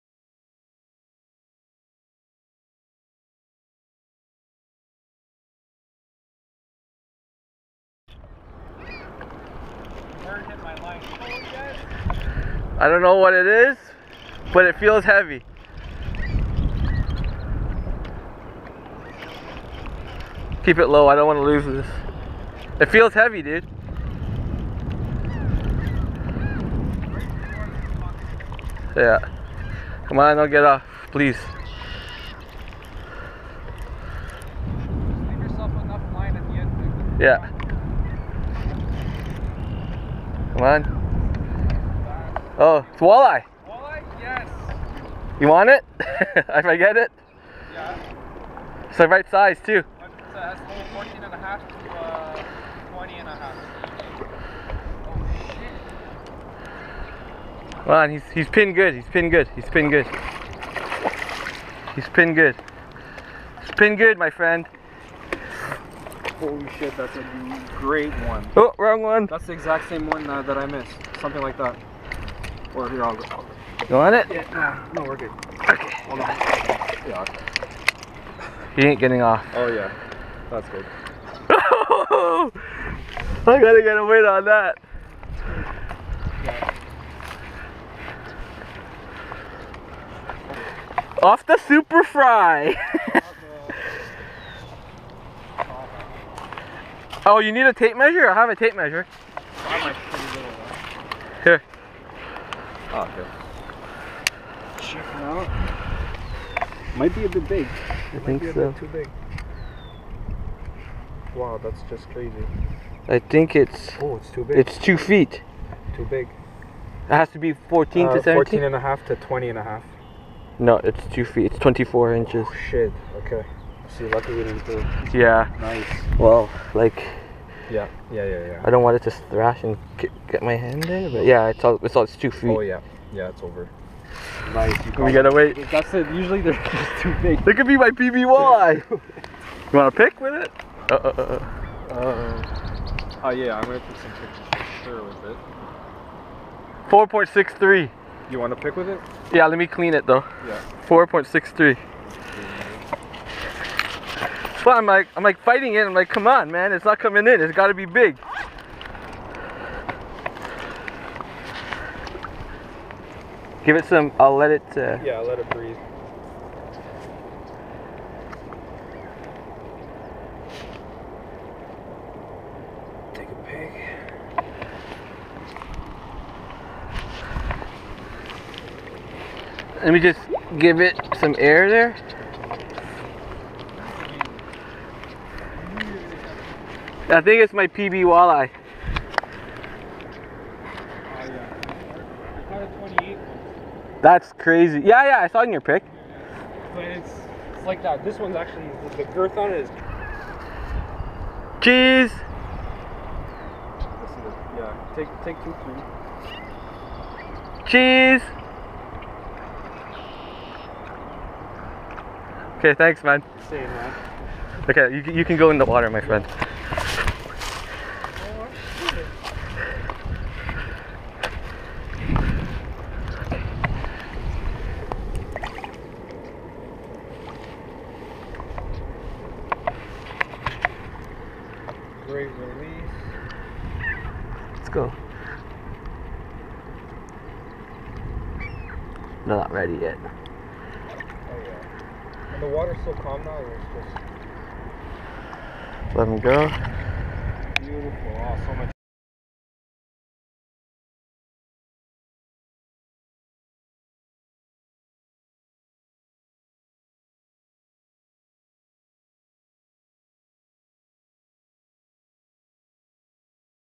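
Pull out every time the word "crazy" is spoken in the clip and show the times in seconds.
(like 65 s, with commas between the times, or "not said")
112 s, 194 s.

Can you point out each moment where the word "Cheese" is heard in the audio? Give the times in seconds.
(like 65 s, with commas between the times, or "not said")
201 s, 207 s.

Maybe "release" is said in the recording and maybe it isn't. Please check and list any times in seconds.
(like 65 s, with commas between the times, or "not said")
232 s.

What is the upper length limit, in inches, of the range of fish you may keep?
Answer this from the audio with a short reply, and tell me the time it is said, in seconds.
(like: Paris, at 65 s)
20 and a half, at 119 s.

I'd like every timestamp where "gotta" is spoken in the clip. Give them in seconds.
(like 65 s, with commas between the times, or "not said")
83 s, 135 s.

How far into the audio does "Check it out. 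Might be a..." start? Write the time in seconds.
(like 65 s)
104 s.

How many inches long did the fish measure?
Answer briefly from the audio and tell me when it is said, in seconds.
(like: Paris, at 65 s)
24 inches, at 121 s.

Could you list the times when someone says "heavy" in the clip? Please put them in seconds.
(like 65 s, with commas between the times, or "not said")
15 s, 23 s.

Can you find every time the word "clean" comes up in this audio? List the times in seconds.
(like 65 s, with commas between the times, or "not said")
149 s.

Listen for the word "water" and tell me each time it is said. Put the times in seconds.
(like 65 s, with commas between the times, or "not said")
215 s, 242 s.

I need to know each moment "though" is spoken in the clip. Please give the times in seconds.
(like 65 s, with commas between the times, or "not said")
150 s.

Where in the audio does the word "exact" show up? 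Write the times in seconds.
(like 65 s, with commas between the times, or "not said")
69 s.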